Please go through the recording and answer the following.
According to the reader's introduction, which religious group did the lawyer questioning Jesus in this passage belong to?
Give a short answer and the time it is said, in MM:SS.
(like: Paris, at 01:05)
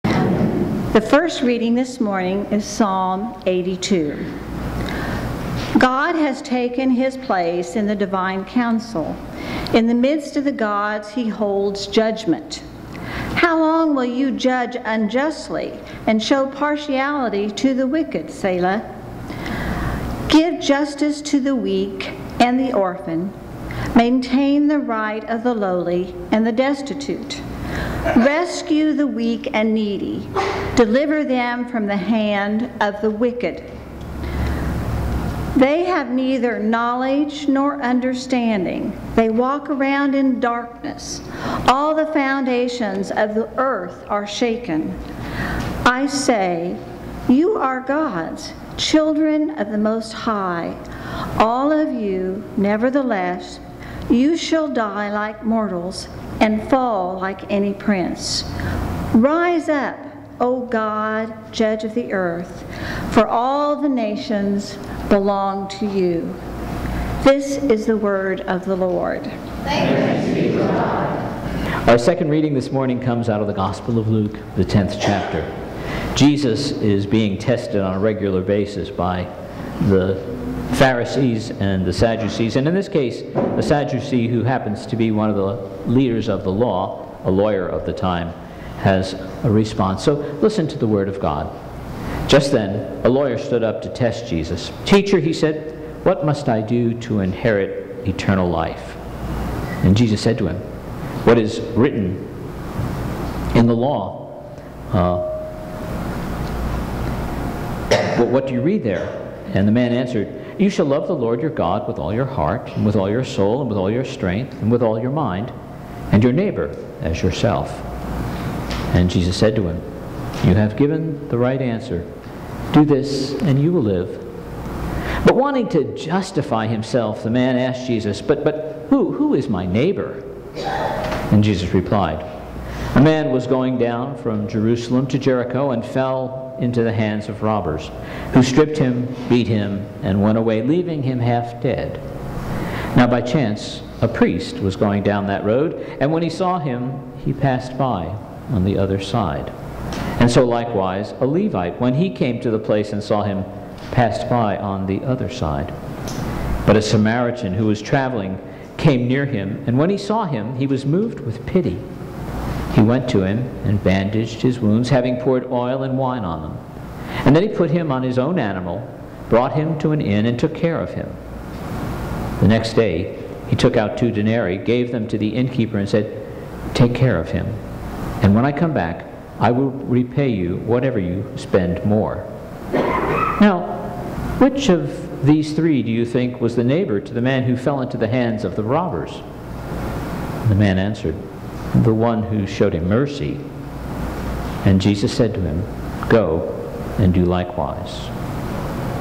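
Sadducee, at 01:23.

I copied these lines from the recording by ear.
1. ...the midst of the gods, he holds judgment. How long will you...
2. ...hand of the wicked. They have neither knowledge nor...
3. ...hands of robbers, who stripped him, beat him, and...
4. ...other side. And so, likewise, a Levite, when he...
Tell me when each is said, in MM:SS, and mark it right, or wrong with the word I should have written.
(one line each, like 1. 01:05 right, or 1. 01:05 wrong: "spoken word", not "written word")
1. 00:09 right
2. 00:31 right
3. 02:16 right
4. 02:28 right.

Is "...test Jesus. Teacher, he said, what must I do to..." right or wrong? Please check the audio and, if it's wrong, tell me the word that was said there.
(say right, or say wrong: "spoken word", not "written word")
right.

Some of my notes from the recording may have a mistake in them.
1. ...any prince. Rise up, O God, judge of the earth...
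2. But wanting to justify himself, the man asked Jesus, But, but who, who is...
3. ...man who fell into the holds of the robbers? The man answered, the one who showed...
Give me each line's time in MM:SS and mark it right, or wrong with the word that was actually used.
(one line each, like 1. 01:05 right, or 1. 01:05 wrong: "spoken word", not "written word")
1. 00:57 right
2. 02:05 right
3. 03:07 wrong: "hands", not "holds".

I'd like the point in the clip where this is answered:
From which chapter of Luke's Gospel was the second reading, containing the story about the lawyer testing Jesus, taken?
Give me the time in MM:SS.
01:14.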